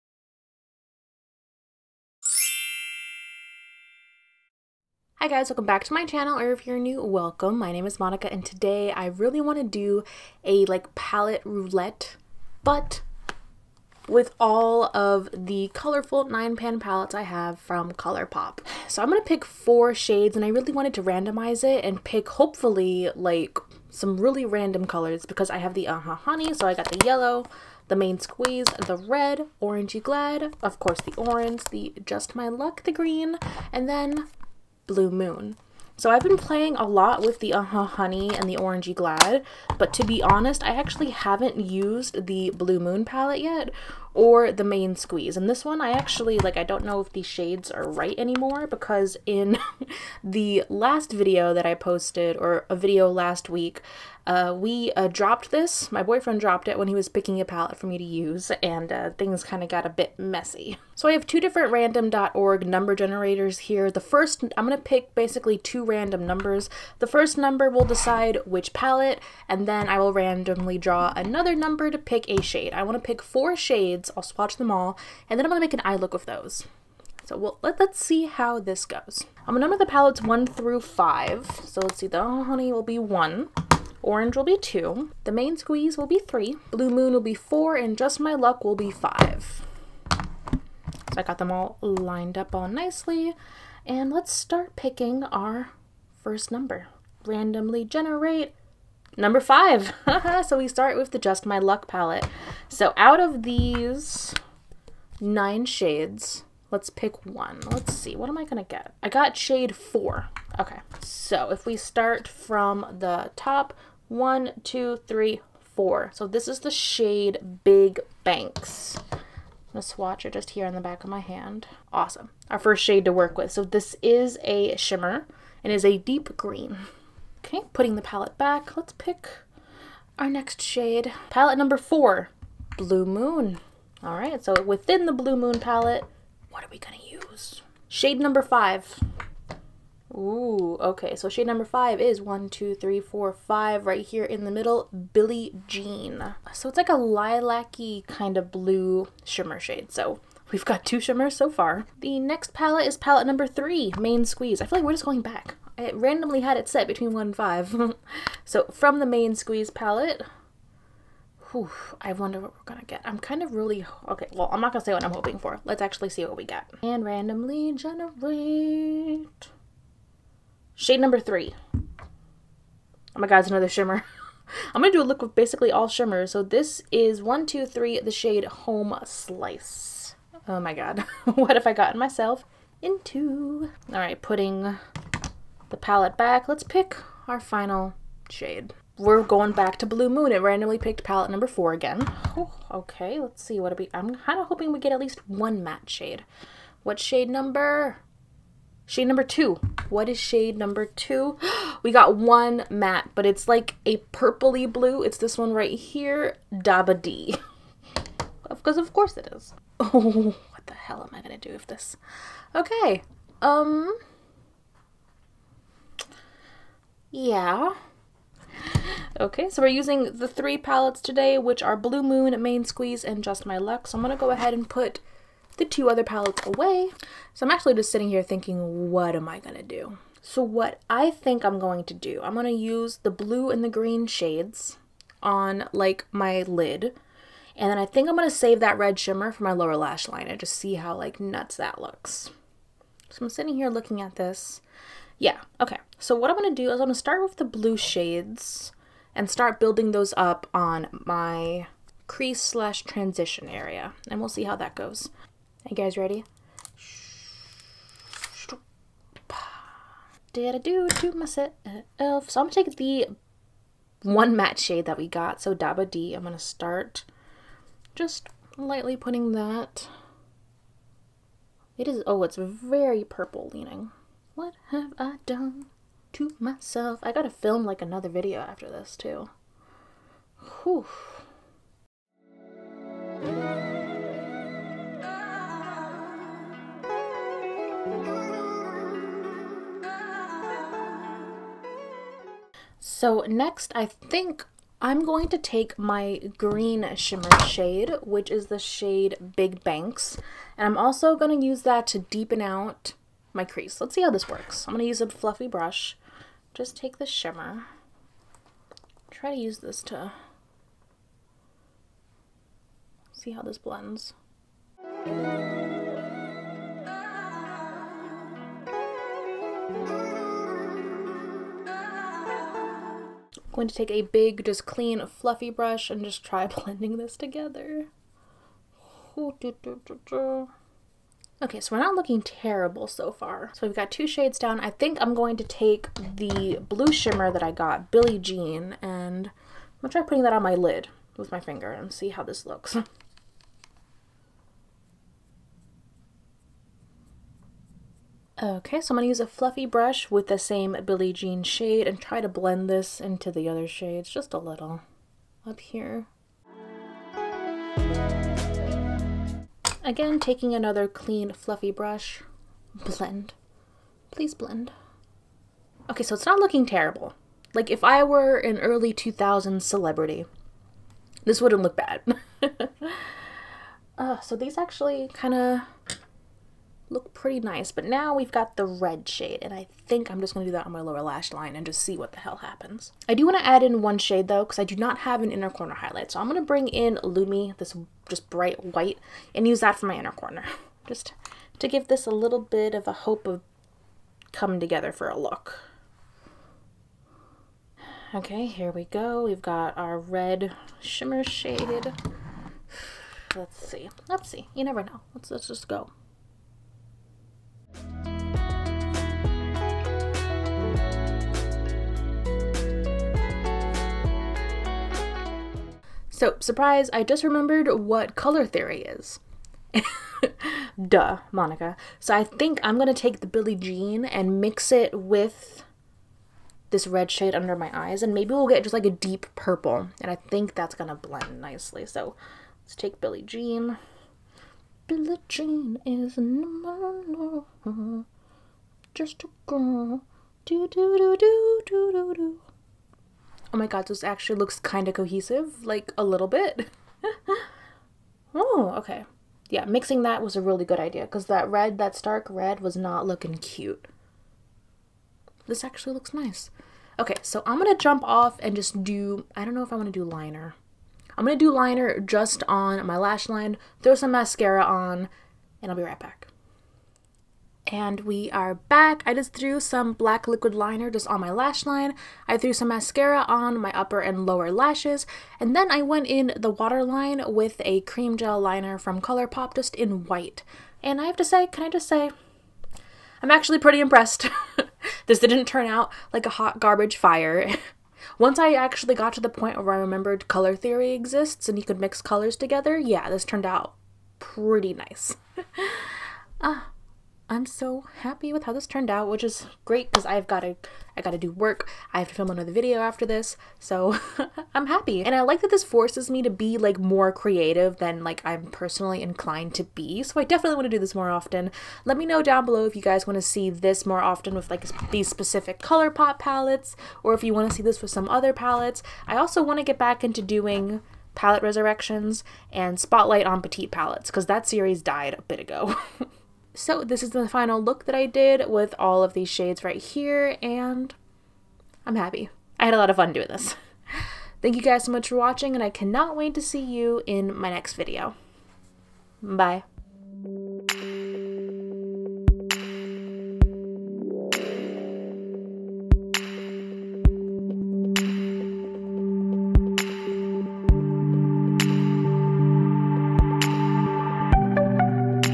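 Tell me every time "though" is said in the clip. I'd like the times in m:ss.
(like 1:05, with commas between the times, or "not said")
6:24.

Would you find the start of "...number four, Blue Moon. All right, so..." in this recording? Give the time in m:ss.
2:11.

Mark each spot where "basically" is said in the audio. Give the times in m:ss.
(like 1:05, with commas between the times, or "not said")
1:05, 2:55.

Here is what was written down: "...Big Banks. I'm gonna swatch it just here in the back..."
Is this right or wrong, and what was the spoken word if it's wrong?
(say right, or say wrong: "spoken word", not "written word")
right.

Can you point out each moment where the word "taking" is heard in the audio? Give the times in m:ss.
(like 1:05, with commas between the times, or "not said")
6:00.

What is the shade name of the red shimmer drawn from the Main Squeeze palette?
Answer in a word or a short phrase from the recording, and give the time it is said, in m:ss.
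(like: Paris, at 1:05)
Home Slice, at 2:58.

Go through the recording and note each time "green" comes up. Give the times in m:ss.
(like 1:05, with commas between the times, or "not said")
0:32, 2:06, 3:53, 4:56.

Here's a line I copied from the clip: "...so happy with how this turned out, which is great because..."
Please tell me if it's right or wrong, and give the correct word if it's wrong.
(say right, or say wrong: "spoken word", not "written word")
right.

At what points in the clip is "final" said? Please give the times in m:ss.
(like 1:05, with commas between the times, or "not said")
3:07, 8:47.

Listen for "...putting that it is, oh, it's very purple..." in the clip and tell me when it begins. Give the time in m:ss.
4:28.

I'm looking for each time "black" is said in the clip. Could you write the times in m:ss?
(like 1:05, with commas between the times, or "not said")
7:49.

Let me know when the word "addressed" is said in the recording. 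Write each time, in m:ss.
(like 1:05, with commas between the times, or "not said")
not said.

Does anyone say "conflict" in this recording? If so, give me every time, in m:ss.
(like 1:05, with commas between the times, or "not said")
not said.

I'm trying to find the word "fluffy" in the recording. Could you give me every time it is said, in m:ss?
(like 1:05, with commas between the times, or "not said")
5:05, 5:25, 5:49, 6:01.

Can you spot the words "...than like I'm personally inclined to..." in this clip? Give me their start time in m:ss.
8:27.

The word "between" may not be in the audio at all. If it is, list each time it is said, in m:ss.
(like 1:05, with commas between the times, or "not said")
2:36.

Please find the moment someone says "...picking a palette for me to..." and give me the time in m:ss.
0:57.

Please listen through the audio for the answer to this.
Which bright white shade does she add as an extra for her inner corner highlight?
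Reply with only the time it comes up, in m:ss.
6:27.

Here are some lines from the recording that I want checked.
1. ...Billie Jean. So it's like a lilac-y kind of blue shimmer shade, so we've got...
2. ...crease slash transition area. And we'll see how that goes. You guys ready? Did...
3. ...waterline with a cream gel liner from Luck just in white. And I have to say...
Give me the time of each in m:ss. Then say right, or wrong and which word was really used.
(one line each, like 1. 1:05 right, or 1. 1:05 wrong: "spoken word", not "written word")
1. 2:25 right
2. 4:12 right
3. 7:56 wrong: "ColourPop", not "Luck".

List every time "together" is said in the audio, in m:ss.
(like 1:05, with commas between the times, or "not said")
5:27, 6:34, 8:12.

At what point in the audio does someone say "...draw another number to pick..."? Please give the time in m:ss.
1:10.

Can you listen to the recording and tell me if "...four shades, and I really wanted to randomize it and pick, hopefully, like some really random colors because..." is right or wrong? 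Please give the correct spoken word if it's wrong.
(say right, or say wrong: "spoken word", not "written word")
right.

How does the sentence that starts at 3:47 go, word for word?
So I'm actually just sitting here thinking, what am I going to do?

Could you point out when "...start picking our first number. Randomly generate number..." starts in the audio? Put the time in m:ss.
1:34.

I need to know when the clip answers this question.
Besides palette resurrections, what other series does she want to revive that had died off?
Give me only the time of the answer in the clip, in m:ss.
8:42.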